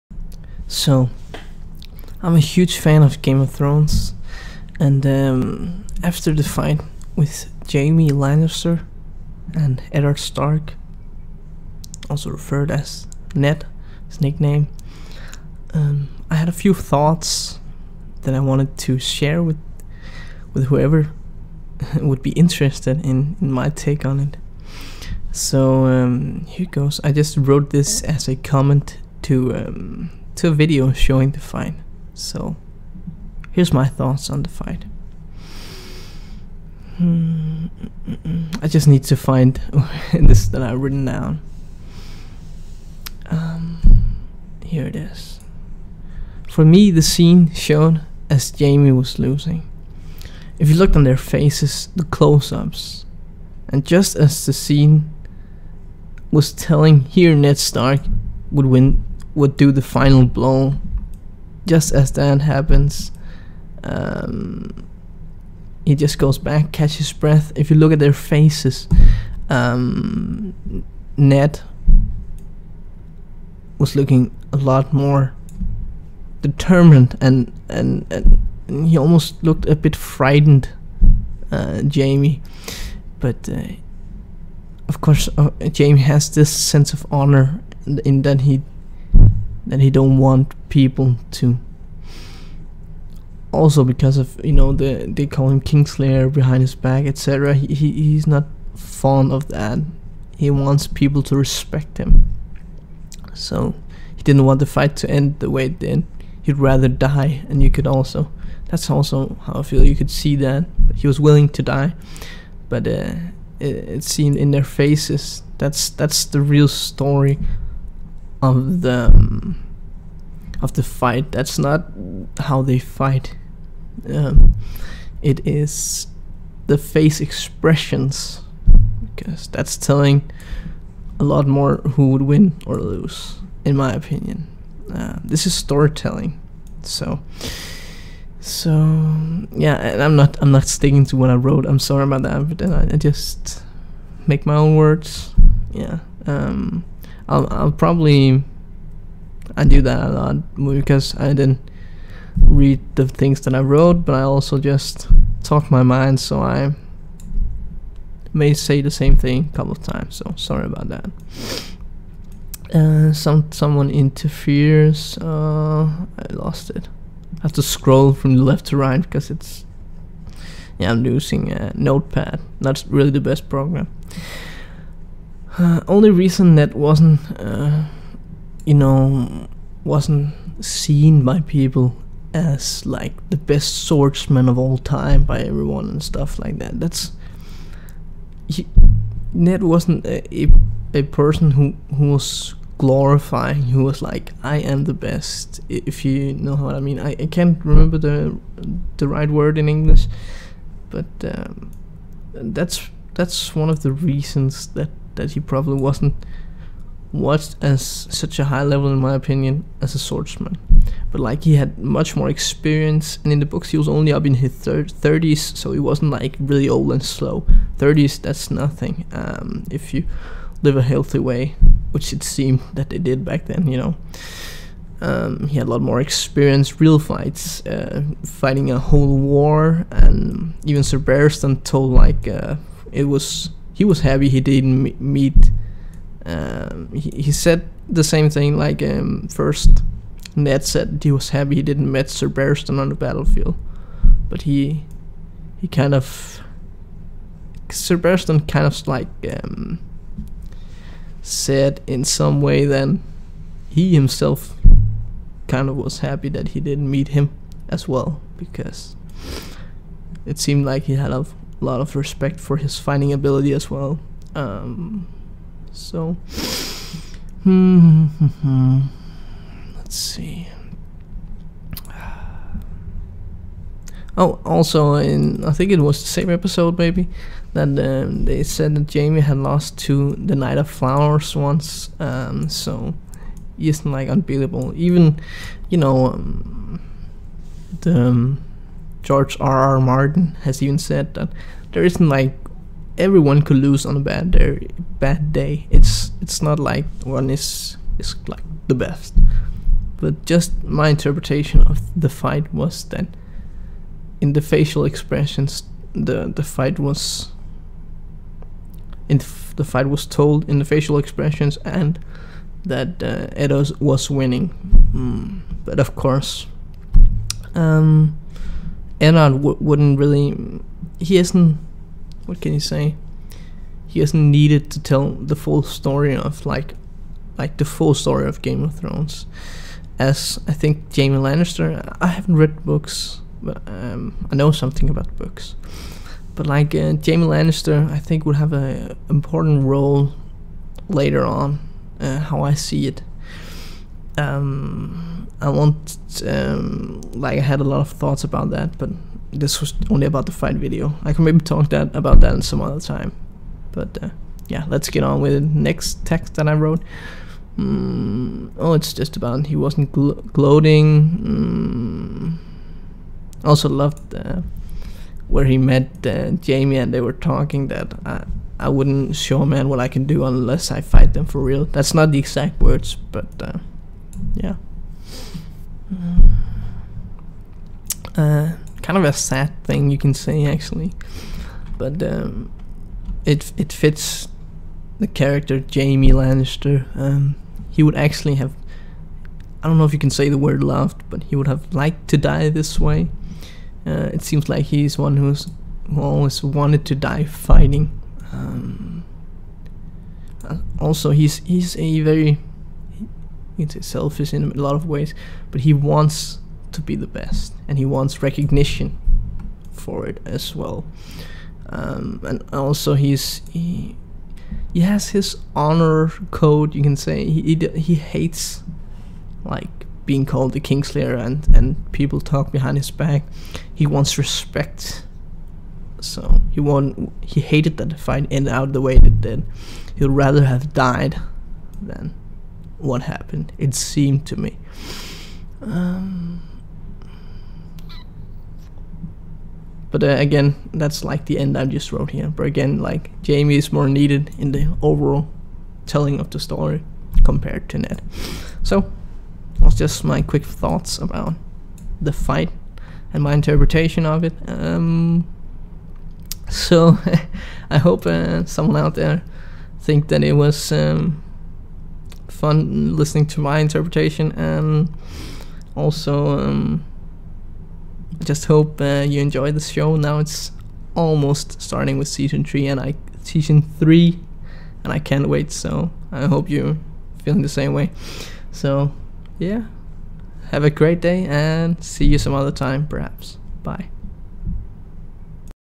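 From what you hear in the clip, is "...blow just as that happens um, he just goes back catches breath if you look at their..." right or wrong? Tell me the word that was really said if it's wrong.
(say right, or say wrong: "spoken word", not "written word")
right.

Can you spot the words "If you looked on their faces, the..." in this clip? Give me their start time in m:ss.
0:50.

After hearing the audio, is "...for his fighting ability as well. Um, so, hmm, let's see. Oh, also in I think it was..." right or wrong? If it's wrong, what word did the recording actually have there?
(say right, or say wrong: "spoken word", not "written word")
right.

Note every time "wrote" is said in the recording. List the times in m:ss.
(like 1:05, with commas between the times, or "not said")
0:27, 2:21, 2:33, 5:56, 7:21.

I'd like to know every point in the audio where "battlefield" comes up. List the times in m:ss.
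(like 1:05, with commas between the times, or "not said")
4:02.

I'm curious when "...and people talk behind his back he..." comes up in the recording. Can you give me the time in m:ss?
7:01.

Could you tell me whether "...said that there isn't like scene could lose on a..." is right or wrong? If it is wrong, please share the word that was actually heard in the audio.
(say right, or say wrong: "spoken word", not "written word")
wrong: "everyone", not "scene".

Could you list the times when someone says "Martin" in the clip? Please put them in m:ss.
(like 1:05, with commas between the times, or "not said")
4:49.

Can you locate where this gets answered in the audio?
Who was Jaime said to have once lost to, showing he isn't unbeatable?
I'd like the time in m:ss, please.
4:40.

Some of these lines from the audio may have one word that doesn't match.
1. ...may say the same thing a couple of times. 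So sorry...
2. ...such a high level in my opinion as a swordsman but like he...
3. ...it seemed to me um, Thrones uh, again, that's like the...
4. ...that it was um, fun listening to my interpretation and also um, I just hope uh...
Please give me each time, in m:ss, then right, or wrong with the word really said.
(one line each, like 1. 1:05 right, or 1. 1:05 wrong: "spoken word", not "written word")
1. 2:38 right
2. 3:28 right
3. 7:13 wrong: "But", not "Thrones"
4. 7:40 right.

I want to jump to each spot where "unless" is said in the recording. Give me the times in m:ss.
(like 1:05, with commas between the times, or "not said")
6:10.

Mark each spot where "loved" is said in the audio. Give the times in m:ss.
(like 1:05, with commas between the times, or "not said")
6:03, 6:30.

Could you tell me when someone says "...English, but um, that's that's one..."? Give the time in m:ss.
3:19.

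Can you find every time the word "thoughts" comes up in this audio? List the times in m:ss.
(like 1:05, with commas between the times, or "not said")
0:16, 0:33, 5:47, 7:30.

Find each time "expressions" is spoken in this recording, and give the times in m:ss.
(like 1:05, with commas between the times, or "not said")
2:07, 5:04, 5:10.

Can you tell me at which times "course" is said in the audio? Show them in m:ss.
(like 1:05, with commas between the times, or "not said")
1:25, 5:15.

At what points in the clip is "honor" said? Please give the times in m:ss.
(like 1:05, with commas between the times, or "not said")
1:27, 6:55.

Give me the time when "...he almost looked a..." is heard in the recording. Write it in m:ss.
1:18.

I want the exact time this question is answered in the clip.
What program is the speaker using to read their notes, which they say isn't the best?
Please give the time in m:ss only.
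2:51.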